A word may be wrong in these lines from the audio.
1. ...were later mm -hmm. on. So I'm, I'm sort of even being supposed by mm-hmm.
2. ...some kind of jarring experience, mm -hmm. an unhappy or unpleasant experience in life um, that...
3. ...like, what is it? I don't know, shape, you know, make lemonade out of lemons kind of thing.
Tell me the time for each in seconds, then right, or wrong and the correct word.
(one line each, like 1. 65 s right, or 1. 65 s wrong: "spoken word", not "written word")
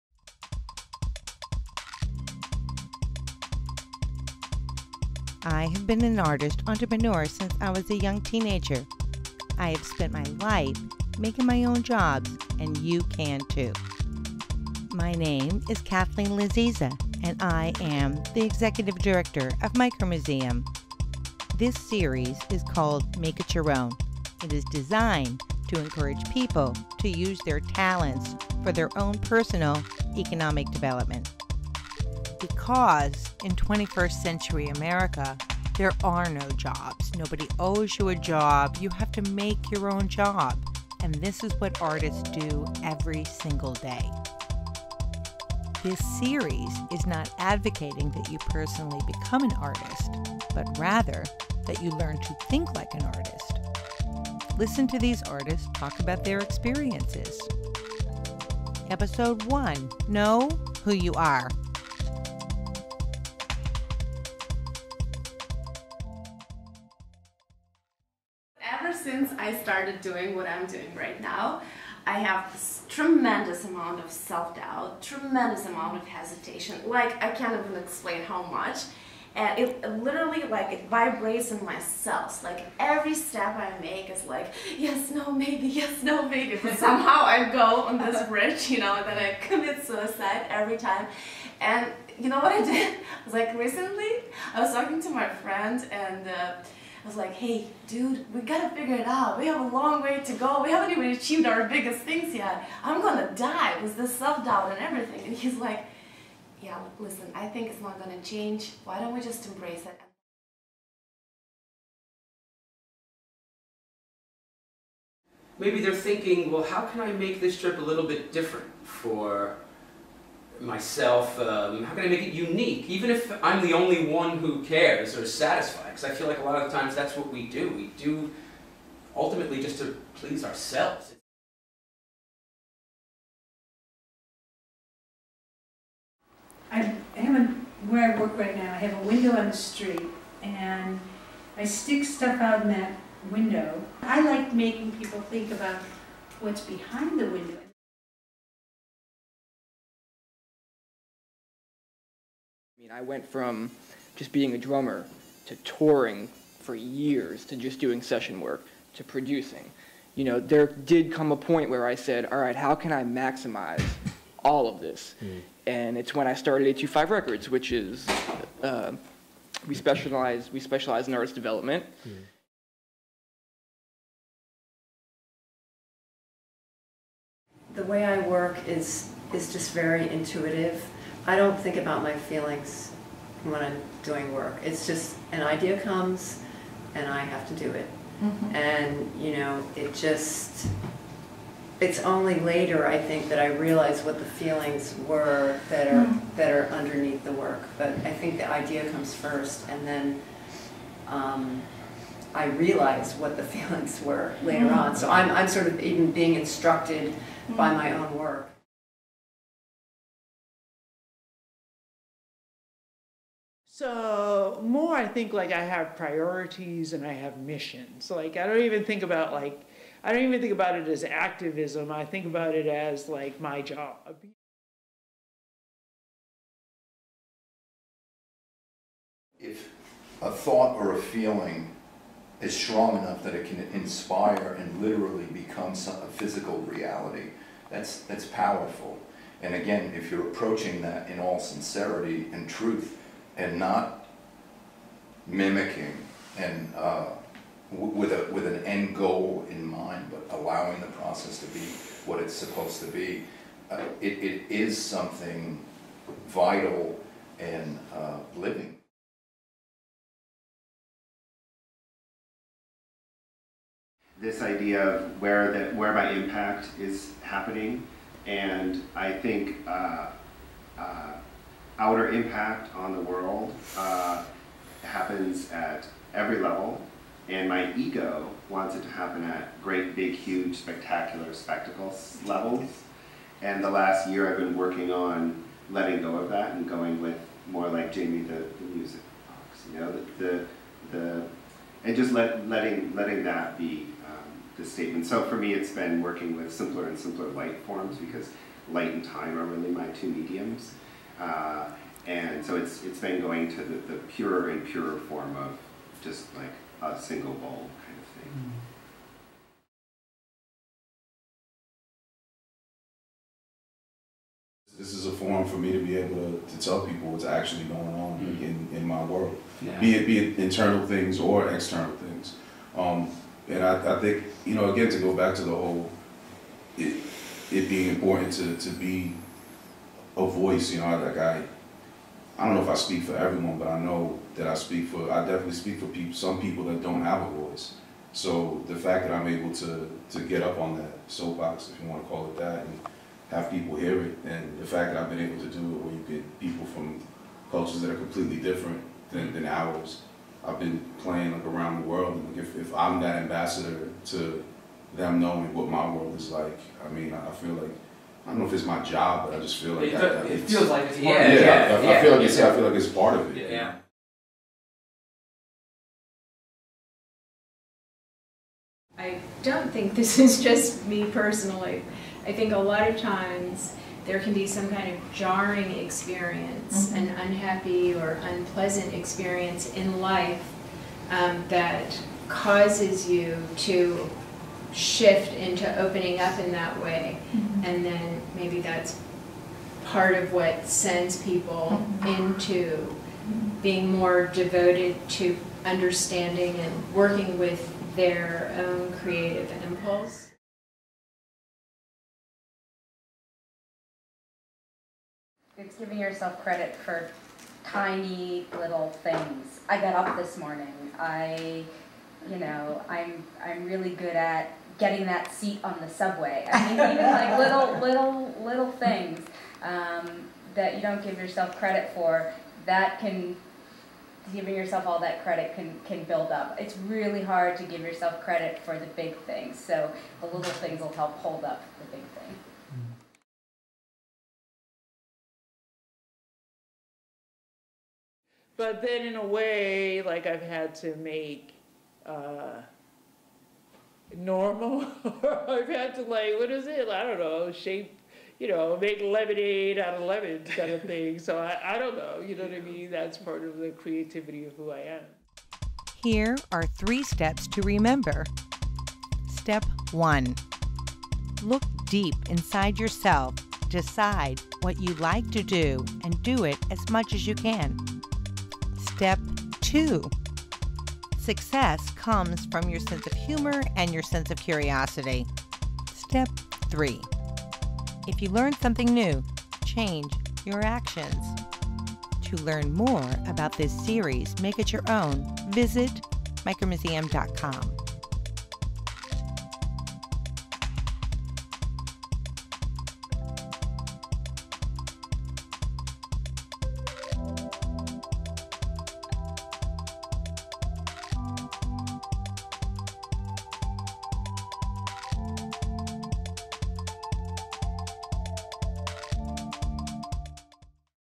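1. 204 s wrong: "instructed", not "supposed"
2. 374 s right
3. 446 s right.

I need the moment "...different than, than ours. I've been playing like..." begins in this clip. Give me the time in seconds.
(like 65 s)
348 s.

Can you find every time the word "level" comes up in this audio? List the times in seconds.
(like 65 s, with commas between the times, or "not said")
276 s, 282 s.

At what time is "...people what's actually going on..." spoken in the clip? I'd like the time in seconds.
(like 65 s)
316 s.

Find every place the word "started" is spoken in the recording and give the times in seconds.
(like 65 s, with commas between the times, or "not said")
69 s, 166 s.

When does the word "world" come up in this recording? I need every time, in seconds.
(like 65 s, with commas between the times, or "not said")
273 s, 319 s, 351 s, 355 s.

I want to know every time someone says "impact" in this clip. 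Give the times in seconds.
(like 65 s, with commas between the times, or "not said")
266 s, 272 s.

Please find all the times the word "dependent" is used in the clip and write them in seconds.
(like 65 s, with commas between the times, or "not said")
not said.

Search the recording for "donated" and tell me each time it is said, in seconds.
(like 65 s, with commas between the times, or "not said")
not said.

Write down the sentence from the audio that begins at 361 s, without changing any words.
Yeah, yeah, I, I, feel like it's I feel like it's part of it.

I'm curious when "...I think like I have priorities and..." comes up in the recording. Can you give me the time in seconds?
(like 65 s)
214 s.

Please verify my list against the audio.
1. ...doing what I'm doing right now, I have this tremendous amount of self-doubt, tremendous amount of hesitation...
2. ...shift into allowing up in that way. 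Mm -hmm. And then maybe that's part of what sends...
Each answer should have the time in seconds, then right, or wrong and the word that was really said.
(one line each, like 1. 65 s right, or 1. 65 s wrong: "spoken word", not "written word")
1. 70 s right
2. 384 s wrong: "opening", not "allowing".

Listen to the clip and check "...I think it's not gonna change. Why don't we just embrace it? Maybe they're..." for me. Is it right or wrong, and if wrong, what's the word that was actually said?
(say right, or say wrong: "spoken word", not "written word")
right.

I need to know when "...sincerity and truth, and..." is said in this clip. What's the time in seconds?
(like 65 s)
241 s.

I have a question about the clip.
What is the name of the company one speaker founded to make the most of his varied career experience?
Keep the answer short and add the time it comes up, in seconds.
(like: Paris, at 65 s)
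825 Records, at 166 s.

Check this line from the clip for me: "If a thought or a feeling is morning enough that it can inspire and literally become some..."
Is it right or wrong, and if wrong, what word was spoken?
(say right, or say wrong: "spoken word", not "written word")
wrong: "strong", not "morning".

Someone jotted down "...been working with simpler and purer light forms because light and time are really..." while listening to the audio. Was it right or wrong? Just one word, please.
wrong.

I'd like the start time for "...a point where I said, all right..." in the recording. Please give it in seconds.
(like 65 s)
161 s.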